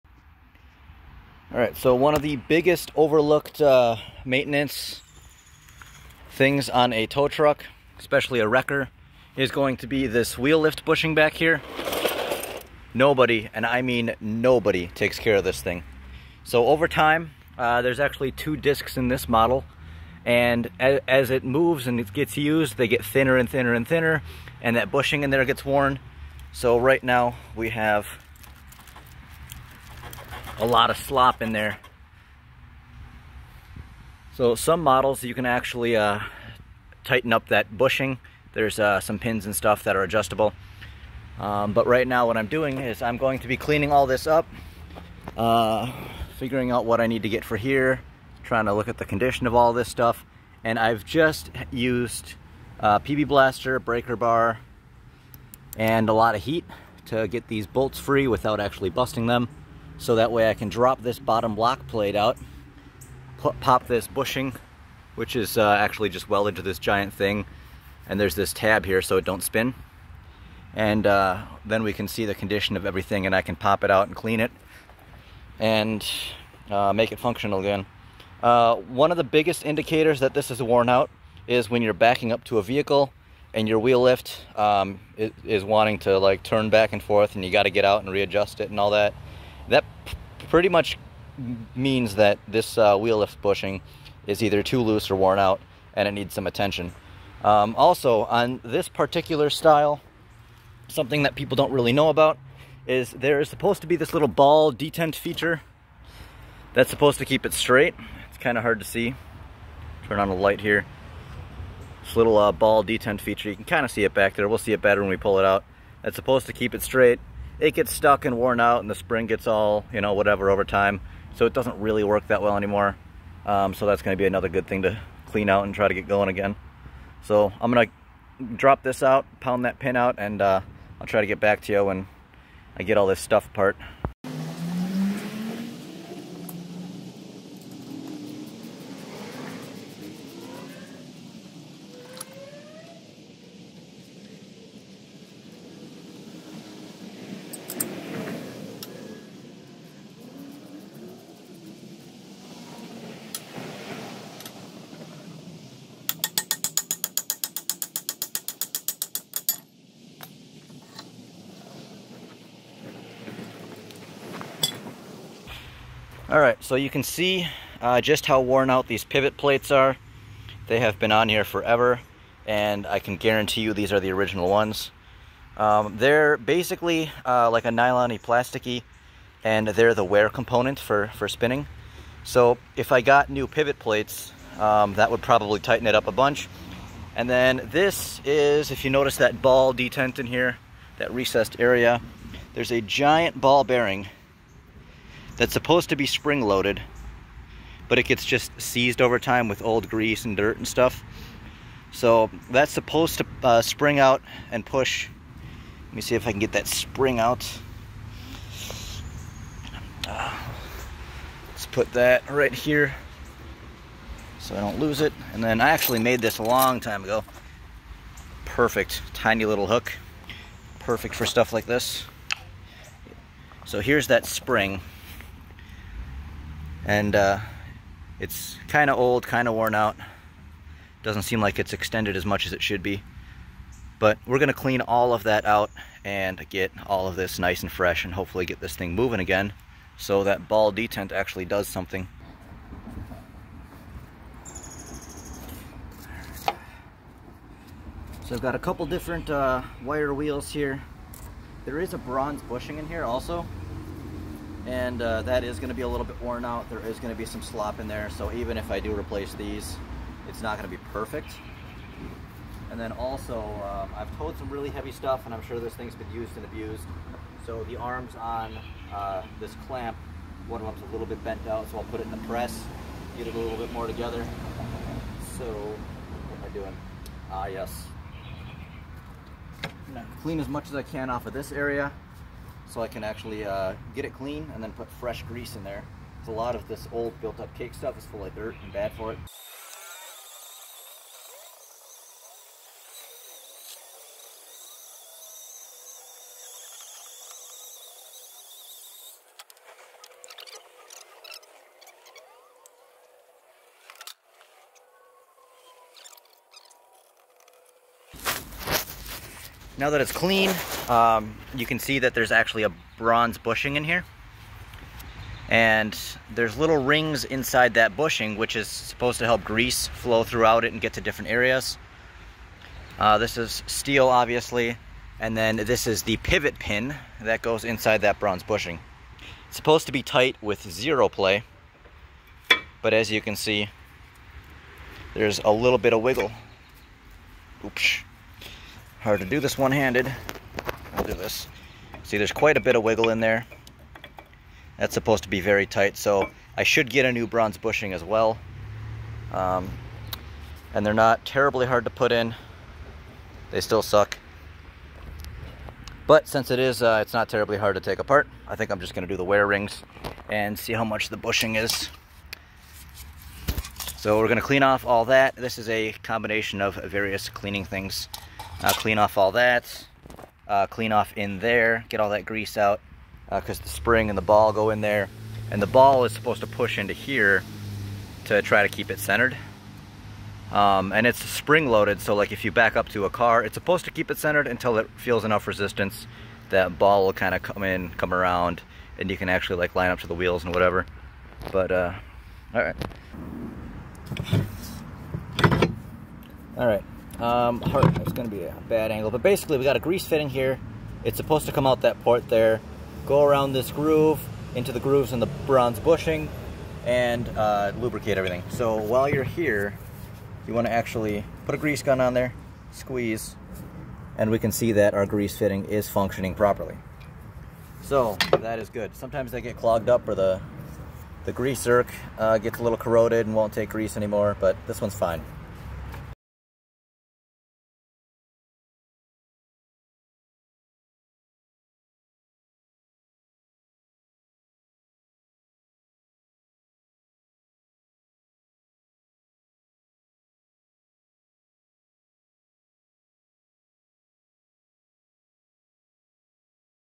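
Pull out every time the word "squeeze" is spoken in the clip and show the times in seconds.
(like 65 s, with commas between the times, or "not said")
412 s.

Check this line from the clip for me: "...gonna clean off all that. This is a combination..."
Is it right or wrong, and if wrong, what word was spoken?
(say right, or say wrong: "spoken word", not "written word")
right.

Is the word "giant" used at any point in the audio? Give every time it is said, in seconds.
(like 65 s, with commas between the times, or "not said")
66 s, 192 s.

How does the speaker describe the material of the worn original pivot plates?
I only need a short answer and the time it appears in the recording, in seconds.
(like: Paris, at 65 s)
nylon-y plasticky, at 177 s.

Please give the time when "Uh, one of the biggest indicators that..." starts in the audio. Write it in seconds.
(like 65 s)
78 s.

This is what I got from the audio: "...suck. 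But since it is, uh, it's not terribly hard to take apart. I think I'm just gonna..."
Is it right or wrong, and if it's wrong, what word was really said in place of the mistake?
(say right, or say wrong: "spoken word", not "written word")
right.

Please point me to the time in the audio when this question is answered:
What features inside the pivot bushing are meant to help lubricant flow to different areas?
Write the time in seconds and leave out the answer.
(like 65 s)
316 s.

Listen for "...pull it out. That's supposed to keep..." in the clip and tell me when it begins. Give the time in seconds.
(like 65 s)
115 s.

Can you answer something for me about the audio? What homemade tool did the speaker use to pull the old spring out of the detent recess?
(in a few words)
tiny little hook.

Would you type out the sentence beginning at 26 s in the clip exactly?
So right now, we have a lot of slop in there.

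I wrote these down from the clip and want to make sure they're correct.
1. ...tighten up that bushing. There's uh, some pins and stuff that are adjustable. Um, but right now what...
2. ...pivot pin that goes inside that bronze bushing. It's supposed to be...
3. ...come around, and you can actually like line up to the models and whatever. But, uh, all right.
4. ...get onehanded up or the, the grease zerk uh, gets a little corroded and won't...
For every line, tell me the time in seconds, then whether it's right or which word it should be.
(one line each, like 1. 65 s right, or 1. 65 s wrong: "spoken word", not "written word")
1. 37 s right
2. 326 s right
3. 387 s wrong: "wheels", not "models"
4. 419 s wrong: "clogged", not "onehanded".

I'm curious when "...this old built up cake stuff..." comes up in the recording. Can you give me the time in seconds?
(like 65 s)
286 s.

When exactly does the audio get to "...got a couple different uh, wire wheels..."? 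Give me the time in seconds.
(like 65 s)
248 s.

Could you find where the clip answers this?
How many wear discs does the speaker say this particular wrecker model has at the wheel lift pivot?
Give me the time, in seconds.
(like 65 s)
18 s.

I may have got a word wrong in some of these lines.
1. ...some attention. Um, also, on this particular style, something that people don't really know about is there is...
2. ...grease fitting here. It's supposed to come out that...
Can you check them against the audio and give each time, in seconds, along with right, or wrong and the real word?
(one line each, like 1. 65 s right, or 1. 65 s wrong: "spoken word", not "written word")
1. 96 s right
2. 399 s right.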